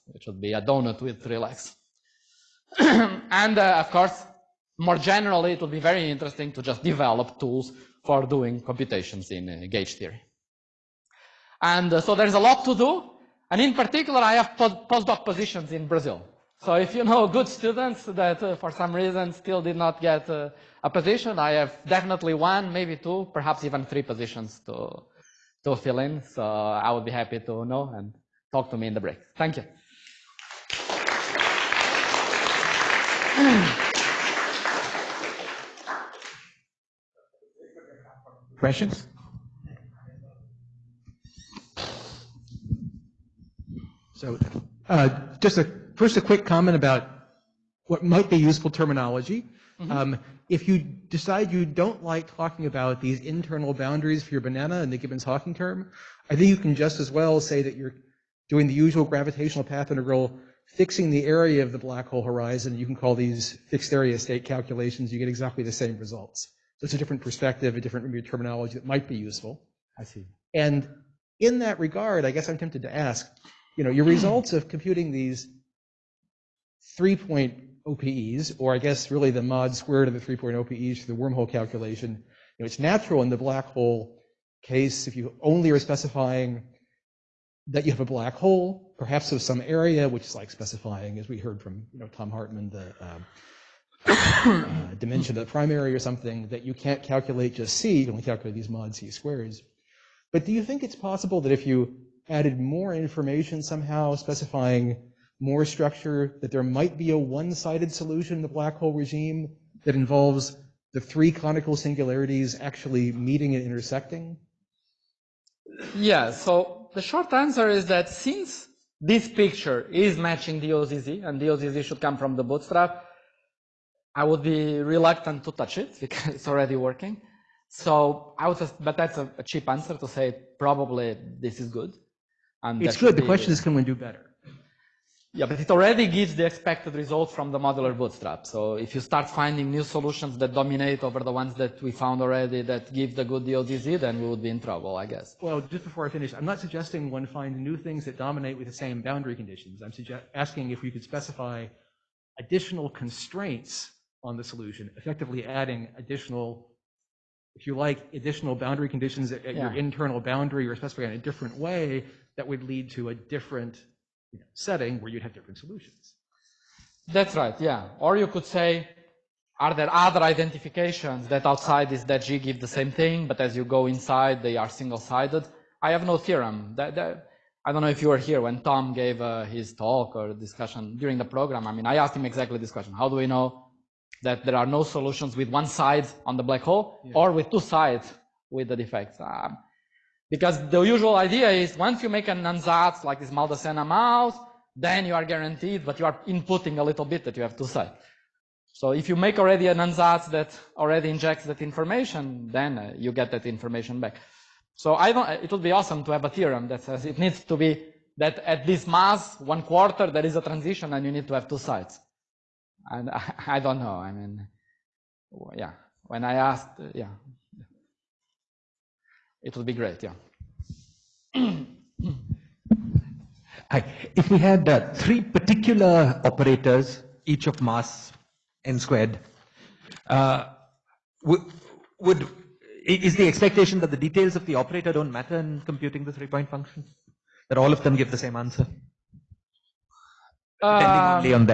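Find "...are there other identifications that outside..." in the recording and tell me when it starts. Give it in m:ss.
2:49.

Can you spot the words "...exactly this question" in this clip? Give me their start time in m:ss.
3:02.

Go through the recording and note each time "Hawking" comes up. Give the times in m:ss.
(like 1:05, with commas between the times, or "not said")
0:54.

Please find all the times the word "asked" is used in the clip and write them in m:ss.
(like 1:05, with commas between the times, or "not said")
3:01, 3:36.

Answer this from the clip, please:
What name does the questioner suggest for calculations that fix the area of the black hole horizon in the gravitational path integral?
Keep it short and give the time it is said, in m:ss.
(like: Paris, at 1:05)
fixed area state calculations, at 1:03.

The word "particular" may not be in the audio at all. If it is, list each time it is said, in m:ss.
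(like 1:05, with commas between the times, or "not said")
0:13, 3:45.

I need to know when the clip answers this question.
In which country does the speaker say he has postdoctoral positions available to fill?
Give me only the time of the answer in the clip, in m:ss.
0:15.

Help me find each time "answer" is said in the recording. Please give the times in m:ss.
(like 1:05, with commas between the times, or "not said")
1:57, 2:09, 3:58.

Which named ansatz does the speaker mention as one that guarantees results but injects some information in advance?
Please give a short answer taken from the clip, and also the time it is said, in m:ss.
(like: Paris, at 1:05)
Maldacena Maoz, at 3:13.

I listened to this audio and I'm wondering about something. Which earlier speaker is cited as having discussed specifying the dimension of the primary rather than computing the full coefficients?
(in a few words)
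Tom Hartman.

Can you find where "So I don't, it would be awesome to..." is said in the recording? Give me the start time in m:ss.
3:24.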